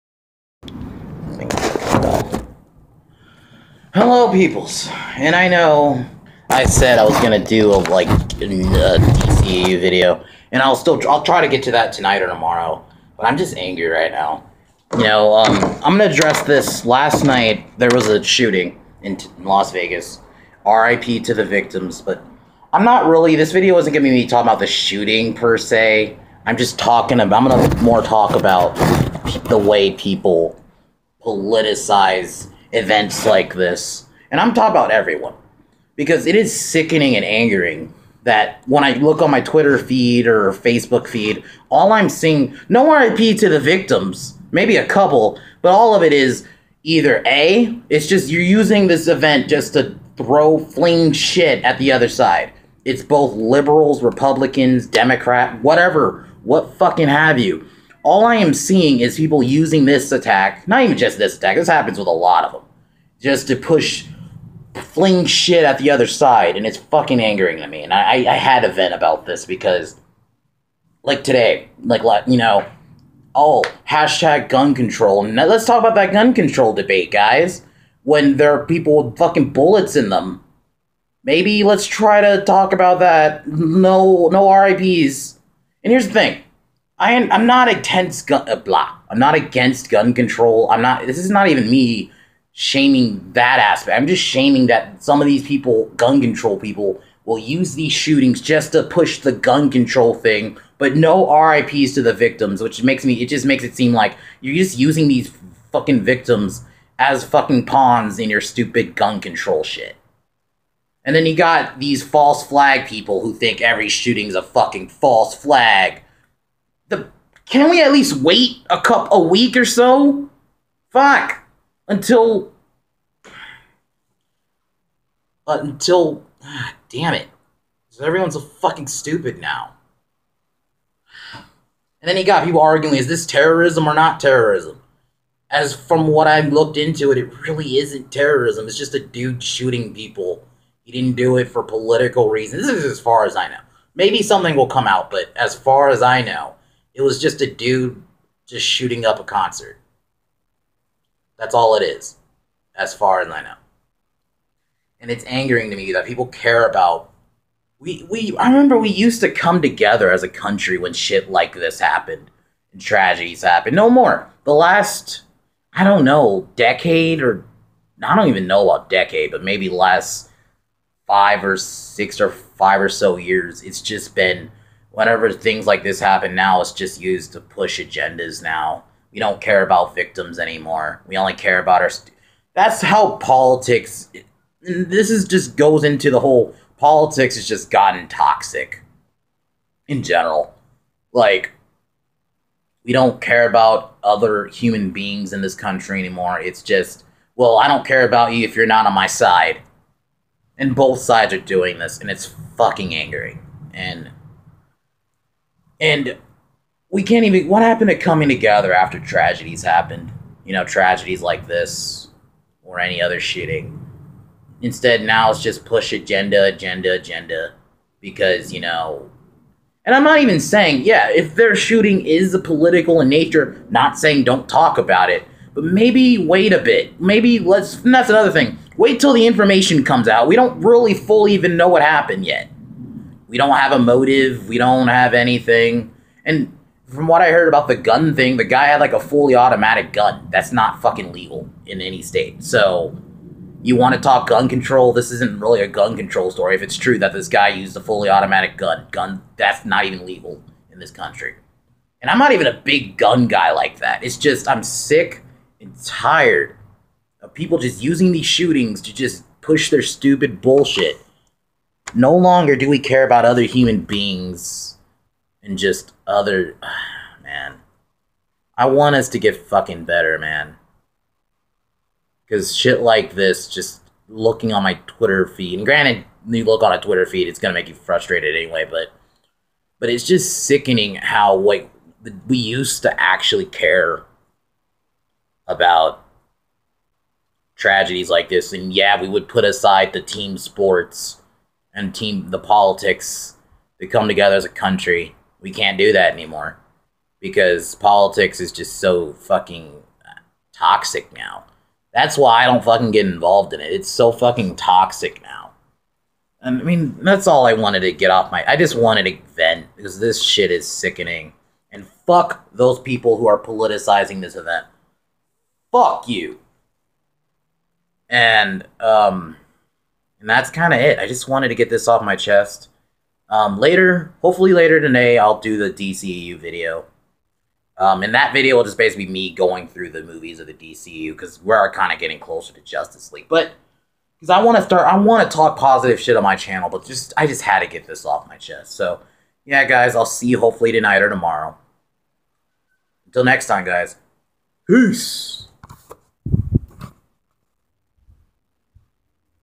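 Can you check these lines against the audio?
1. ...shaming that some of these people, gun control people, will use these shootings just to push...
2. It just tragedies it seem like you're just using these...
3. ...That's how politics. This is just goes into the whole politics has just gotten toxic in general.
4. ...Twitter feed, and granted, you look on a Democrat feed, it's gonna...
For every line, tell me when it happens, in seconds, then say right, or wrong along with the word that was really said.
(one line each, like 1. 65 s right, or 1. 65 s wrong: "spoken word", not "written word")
1. 94 s right
2. 103 s wrong: "makes", not "tragedies"
3. 182 s right
4. 274 s wrong: "Twitter", not "Democrat".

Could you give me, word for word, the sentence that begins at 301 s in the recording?
That's why I don't fucking get involved in it.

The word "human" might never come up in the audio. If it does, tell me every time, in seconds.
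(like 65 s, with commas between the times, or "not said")
194 s, 263 s.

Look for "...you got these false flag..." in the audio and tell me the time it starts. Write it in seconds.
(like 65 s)
111 s.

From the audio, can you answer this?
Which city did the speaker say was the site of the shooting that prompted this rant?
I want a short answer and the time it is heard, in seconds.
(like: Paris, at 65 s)
Las Vegas, at 19 s.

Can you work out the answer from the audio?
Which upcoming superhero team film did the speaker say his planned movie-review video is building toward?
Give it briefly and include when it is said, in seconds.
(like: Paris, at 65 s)
Justice League, at 332 s.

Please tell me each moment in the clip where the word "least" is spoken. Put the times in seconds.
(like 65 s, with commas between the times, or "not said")
117 s.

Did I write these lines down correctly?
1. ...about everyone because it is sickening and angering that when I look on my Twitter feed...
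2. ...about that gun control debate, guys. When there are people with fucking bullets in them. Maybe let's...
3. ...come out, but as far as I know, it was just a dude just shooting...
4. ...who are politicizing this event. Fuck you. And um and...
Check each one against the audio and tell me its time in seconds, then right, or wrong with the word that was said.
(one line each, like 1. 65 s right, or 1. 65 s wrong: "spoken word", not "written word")
1. 34 s right
2. 75 s right
3. 144 s right
4. 313 s right.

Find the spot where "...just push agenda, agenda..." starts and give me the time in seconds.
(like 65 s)
215 s.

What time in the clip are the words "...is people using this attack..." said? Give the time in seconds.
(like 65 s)
59 s.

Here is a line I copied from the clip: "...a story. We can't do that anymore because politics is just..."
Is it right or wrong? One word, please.
wrong.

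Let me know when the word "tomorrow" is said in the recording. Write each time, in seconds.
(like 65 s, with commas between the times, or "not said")
12 s, 341 s.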